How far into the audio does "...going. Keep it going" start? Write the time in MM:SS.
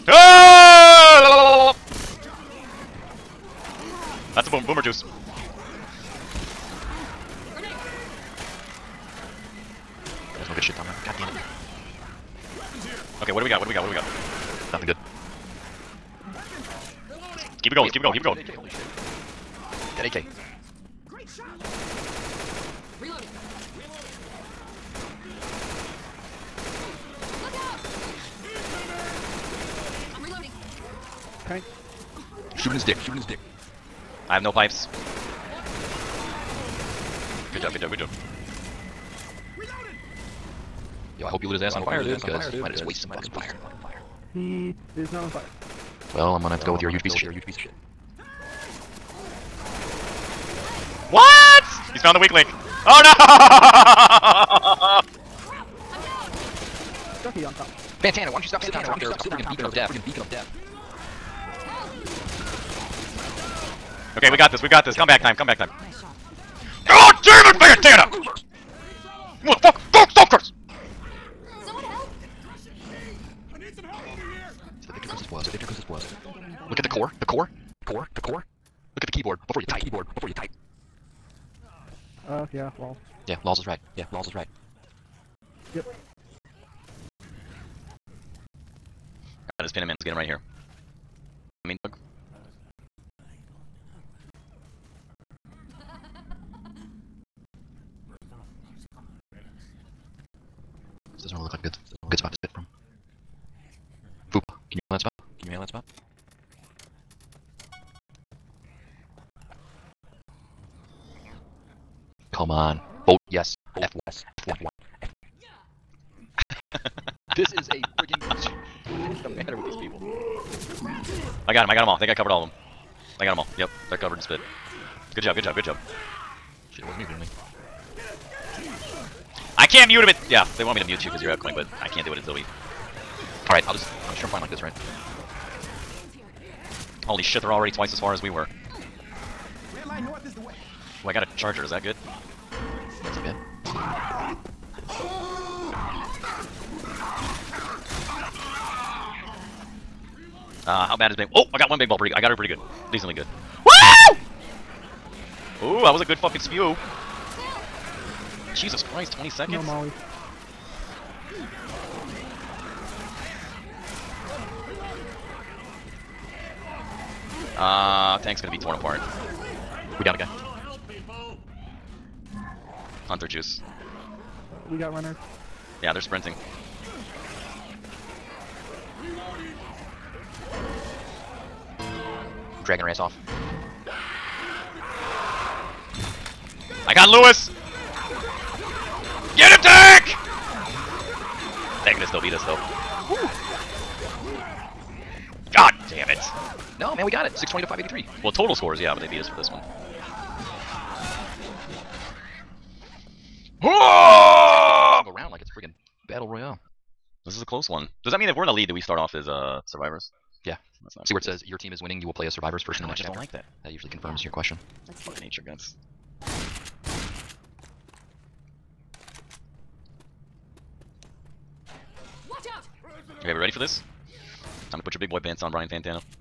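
00:18.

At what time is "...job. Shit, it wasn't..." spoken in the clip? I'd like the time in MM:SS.
02:05.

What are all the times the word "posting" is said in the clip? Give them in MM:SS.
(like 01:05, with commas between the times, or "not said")
not said.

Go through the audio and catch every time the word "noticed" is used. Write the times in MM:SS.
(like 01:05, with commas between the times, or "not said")
not said.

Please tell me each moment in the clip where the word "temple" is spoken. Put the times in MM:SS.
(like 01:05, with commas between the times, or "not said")
not said.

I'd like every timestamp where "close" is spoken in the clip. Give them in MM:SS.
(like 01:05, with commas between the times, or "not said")
03:27.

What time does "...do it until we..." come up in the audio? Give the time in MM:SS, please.
02:12.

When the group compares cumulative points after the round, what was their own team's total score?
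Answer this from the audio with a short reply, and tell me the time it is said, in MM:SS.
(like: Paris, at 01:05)
620, at 03:17.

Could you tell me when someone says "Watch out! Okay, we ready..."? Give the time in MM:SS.
03:42.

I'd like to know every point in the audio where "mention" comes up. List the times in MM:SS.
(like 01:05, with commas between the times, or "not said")
not said.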